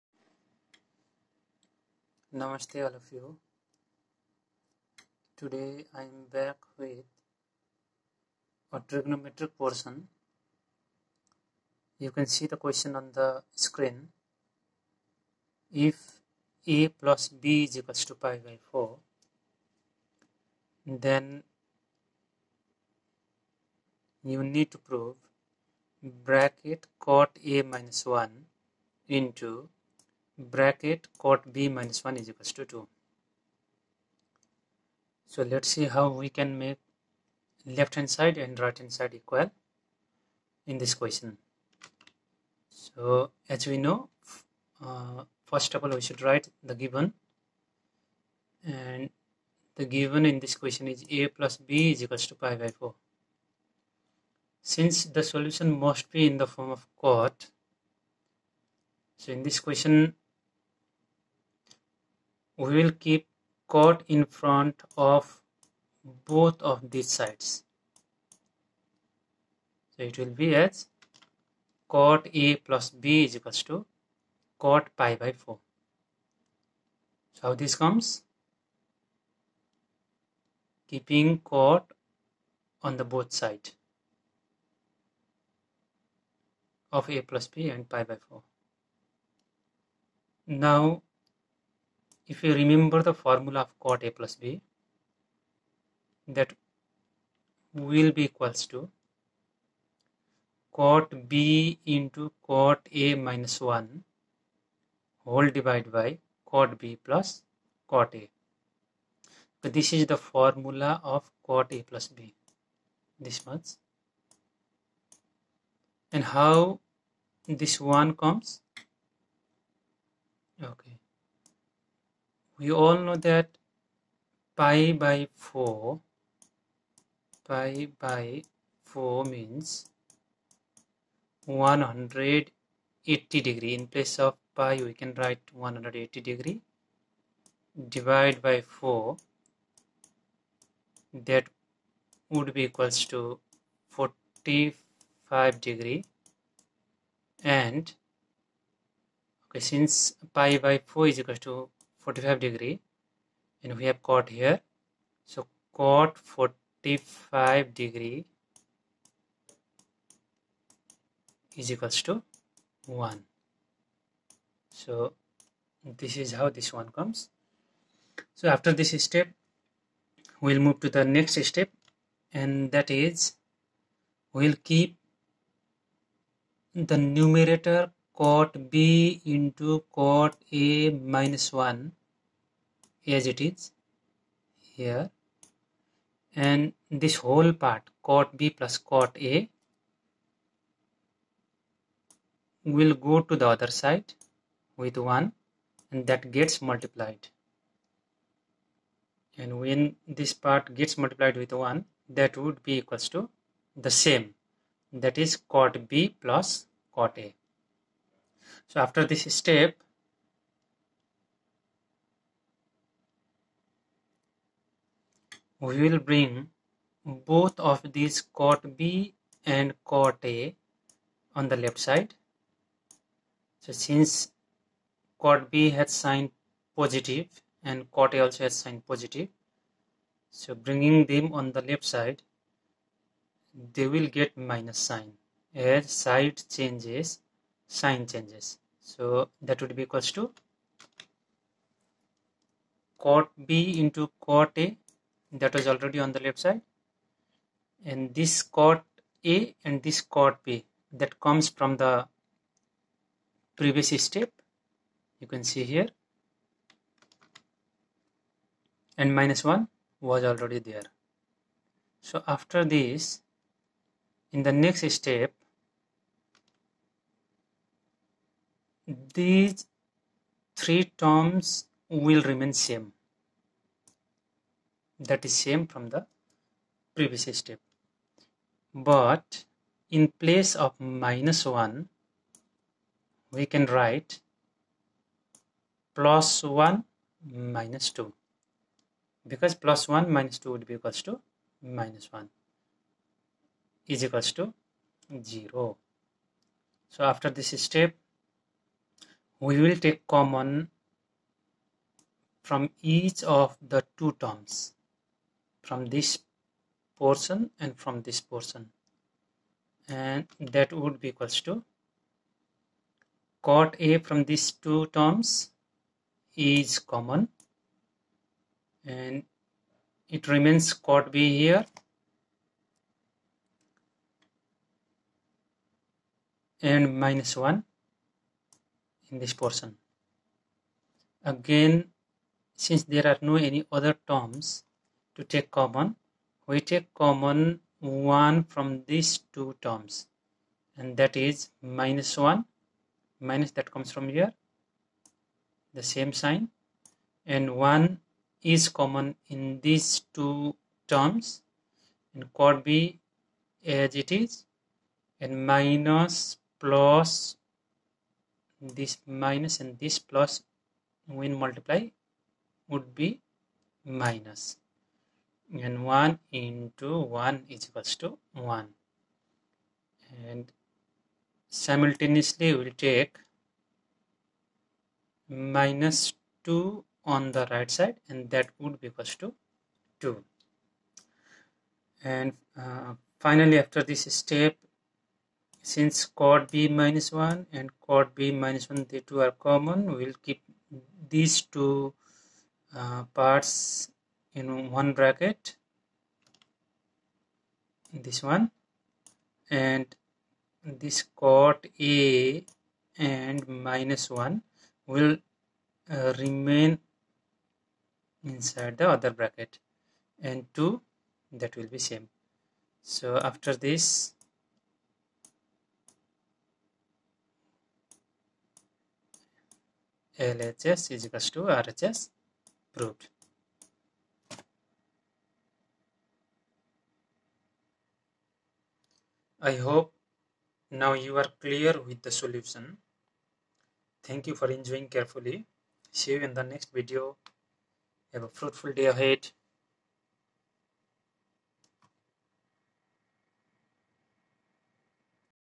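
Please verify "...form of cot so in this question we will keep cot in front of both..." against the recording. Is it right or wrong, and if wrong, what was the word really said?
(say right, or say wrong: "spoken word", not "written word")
right.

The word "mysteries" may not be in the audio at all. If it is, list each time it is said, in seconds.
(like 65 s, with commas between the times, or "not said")
not said.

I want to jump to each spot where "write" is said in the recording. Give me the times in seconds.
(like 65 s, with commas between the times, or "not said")
46 s, 135 s, 283 s.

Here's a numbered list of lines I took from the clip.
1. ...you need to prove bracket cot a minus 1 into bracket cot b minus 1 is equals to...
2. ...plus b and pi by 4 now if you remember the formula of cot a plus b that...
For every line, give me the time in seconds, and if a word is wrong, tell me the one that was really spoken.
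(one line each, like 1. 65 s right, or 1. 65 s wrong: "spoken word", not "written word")
1. 24 s right
2. 87 s right.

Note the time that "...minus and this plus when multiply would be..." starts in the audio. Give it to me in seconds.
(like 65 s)
359 s.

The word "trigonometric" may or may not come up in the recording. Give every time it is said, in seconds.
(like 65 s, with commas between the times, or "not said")
8 s.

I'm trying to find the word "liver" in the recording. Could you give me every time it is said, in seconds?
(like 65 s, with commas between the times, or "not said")
not said.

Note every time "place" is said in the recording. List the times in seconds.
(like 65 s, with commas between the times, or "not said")
133 s, 280 s.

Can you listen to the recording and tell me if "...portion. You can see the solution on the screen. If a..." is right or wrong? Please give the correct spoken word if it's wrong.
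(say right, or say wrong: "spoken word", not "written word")
wrong: "question", not "solution".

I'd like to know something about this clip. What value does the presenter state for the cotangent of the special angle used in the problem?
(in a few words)
1.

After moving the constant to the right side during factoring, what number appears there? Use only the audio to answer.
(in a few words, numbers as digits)
2.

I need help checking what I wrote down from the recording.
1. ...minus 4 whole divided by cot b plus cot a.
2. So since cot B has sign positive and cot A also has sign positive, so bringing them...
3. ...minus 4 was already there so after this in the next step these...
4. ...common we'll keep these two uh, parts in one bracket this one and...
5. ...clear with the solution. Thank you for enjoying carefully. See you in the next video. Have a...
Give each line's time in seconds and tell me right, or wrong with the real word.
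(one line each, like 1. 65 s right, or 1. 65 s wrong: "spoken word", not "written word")
1. 103 s wrong: "1", not "4"
2. 223 s right
3. 259 s wrong: "1", not "4"
4. 389 s right
5. 431 s right.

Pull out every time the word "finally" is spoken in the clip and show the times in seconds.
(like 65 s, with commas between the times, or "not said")
383 s.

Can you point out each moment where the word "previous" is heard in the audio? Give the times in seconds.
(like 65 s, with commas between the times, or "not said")
253 s, 276 s.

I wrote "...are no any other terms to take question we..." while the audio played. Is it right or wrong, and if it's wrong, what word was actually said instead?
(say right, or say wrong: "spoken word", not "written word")
wrong: "common", not "question".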